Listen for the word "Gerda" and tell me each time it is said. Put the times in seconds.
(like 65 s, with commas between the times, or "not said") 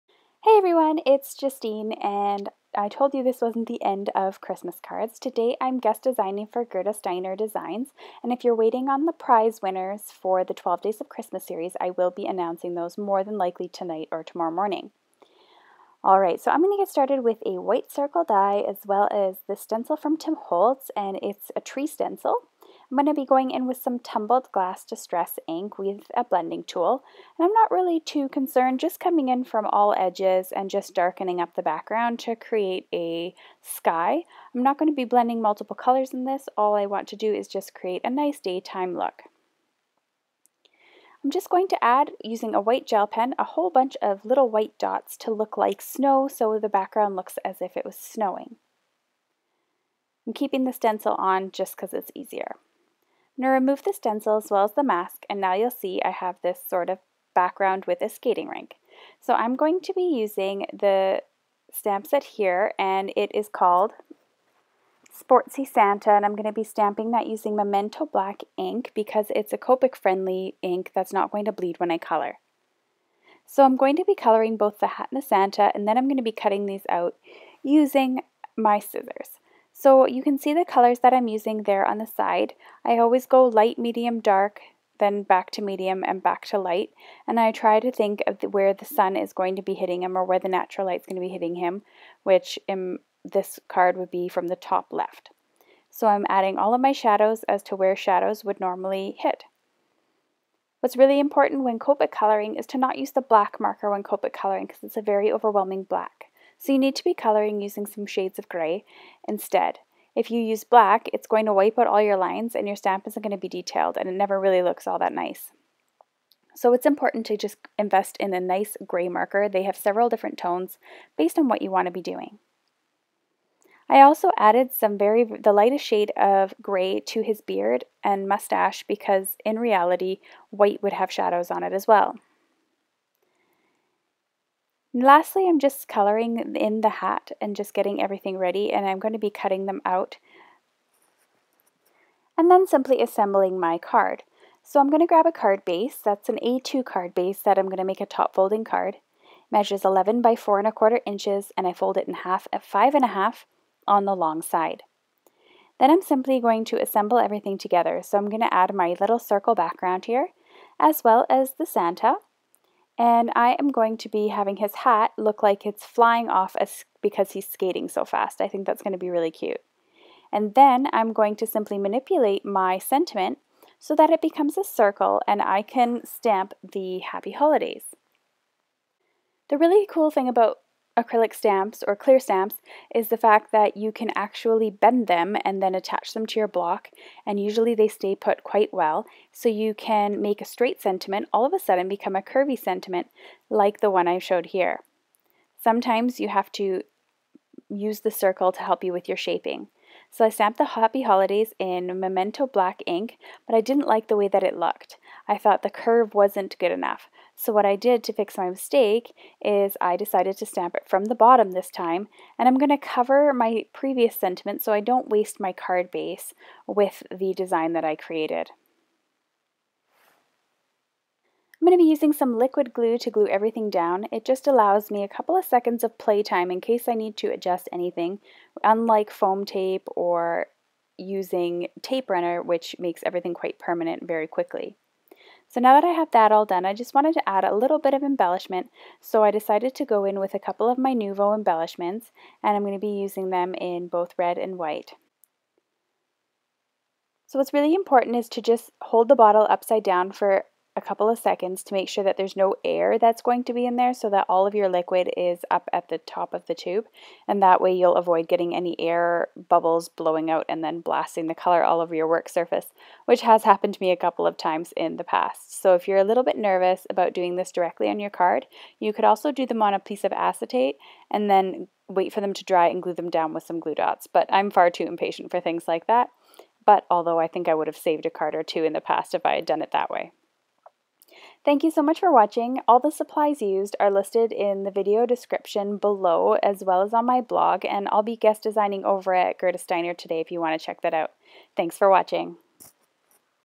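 6 s, 289 s.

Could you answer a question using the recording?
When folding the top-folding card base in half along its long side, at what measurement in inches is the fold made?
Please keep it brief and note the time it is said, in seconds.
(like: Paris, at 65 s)
5 and a half, at 152 s.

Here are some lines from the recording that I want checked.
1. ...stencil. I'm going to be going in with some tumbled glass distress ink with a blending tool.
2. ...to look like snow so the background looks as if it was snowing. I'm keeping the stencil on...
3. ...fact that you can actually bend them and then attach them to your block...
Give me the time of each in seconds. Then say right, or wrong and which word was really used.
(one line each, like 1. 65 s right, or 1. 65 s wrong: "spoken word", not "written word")
1. 21 s right
2. 45 s right
3. 183 s right.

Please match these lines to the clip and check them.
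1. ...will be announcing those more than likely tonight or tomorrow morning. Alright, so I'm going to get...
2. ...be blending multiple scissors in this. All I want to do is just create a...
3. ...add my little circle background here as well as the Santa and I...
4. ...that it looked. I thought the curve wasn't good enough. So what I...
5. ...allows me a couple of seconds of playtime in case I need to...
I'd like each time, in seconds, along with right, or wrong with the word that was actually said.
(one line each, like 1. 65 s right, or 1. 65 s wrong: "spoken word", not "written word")
1. 11 s right
2. 34 s wrong: "colors", not "scissors"
3. 158 s right
4. 204 s right
5. 224 s right.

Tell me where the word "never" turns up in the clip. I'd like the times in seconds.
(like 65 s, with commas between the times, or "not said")
114 s.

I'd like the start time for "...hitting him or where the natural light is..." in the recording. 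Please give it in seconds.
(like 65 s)
89 s.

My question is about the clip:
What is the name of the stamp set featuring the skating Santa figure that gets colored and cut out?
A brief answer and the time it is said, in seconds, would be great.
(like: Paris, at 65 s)
Sportsy Santa, at 65 s.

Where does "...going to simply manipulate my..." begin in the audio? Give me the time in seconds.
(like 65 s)
171 s.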